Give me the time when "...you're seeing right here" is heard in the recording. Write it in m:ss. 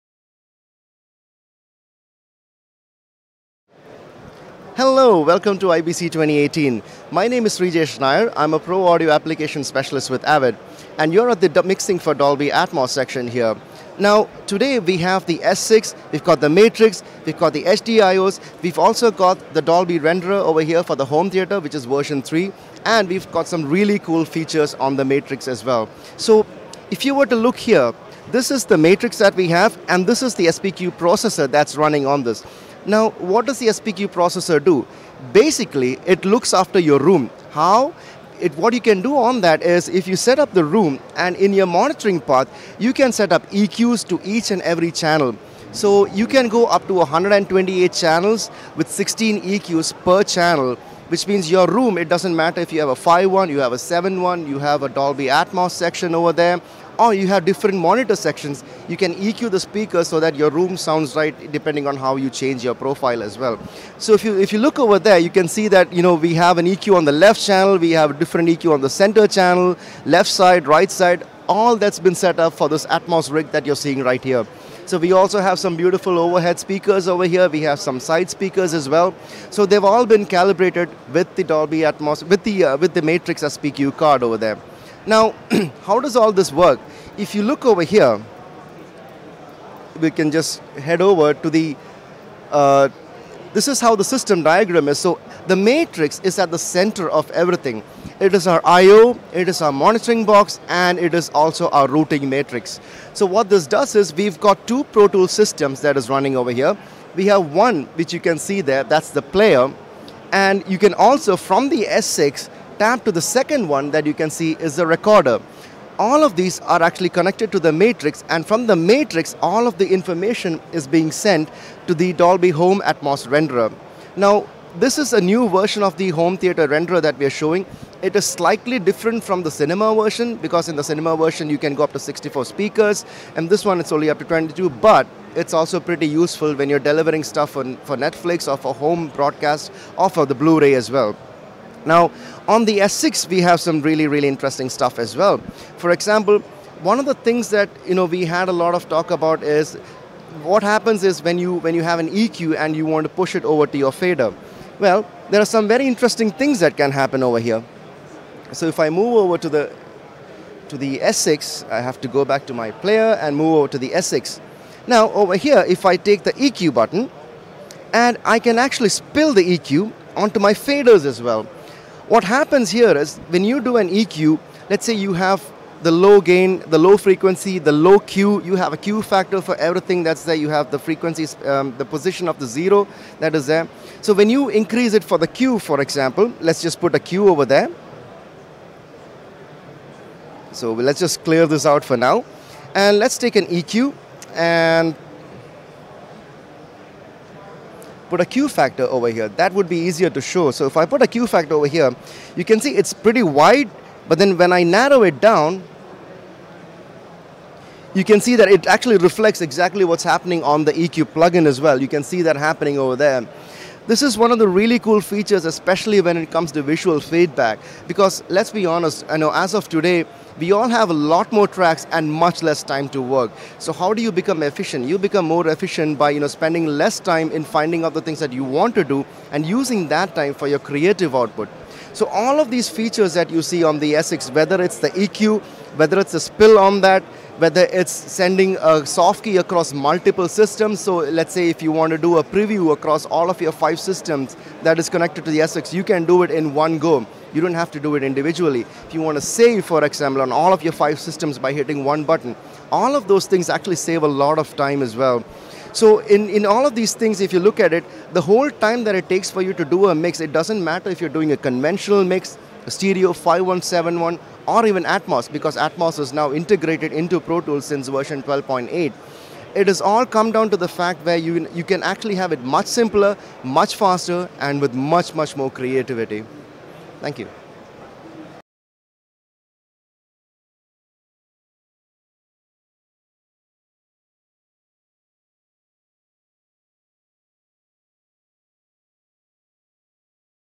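1:13.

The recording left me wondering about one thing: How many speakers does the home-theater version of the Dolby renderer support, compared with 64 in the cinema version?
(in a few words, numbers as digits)
22.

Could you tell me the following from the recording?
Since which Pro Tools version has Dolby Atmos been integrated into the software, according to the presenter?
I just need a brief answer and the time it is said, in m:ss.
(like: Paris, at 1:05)
12.8, at 4:27.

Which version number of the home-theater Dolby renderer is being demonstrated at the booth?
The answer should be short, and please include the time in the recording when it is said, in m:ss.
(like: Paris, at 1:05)
3, at 0:21.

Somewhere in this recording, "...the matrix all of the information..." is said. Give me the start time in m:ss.
1:58.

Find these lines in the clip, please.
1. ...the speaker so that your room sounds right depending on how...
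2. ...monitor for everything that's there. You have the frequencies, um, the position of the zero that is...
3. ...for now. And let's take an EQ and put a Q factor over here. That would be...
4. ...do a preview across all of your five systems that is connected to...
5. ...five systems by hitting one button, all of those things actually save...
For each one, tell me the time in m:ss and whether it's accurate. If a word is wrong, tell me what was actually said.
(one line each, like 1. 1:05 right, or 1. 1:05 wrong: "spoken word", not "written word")
1. 0:59 right
2. 2:59 wrong: "factor", not "monitor"
3. 3:11 right
4. 4:01 right
5. 4:10 right.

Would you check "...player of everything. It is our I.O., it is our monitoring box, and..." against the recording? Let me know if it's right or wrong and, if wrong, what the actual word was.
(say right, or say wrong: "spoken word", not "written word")
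wrong: "center", not "player".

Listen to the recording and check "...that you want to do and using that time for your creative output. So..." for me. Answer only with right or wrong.
right.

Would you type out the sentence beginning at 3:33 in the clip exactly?
This is one of the really cool features, especially when it comes to visual feedback.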